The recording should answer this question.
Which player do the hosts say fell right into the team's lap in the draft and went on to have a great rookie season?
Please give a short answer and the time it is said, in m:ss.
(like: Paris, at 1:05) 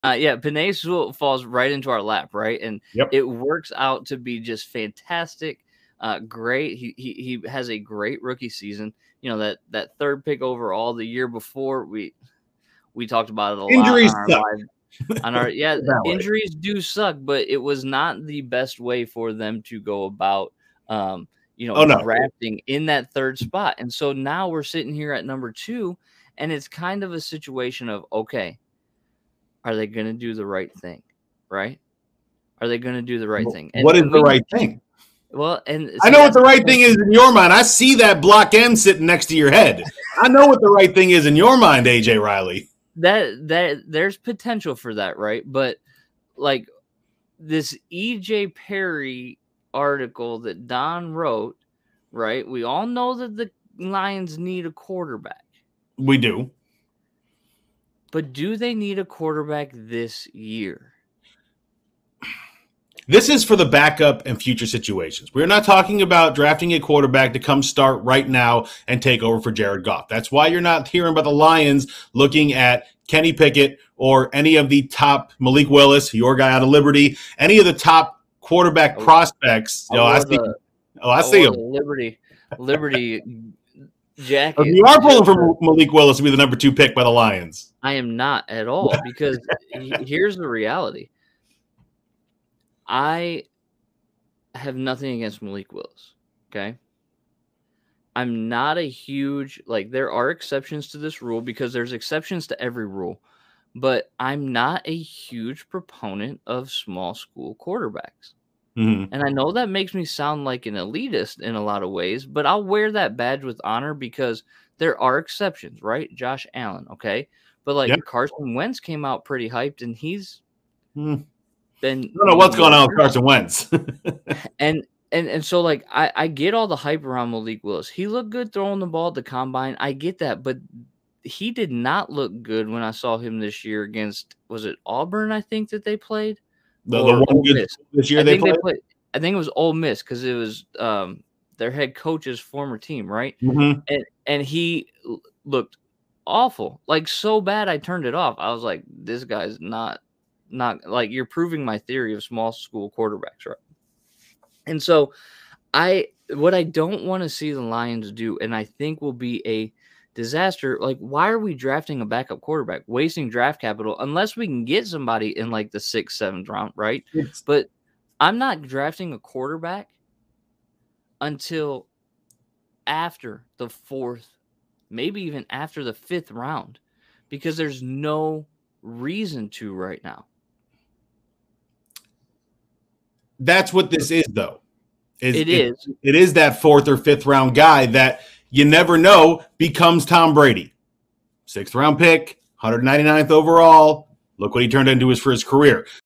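Penei Sewell, at 0:00.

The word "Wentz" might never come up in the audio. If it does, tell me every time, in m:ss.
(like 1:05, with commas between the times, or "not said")
1:58, 2:03.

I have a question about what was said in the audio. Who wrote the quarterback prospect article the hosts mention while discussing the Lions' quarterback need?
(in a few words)
Don.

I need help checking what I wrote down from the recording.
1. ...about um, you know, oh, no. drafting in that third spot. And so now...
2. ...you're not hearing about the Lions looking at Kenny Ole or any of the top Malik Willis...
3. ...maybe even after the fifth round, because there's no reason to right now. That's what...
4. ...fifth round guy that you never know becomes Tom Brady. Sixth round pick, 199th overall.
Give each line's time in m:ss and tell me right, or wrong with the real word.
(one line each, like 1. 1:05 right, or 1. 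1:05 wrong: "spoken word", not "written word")
1. 0:20 right
2. 1:10 wrong: "Pickett", not "Ole"
3. 2:54 right
4. 3:06 right.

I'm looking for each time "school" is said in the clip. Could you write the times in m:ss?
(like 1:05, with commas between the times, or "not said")
1:47, 2:32.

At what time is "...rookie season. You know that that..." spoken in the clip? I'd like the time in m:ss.
0:08.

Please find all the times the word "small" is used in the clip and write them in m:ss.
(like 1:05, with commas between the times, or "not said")
1:46, 2:32.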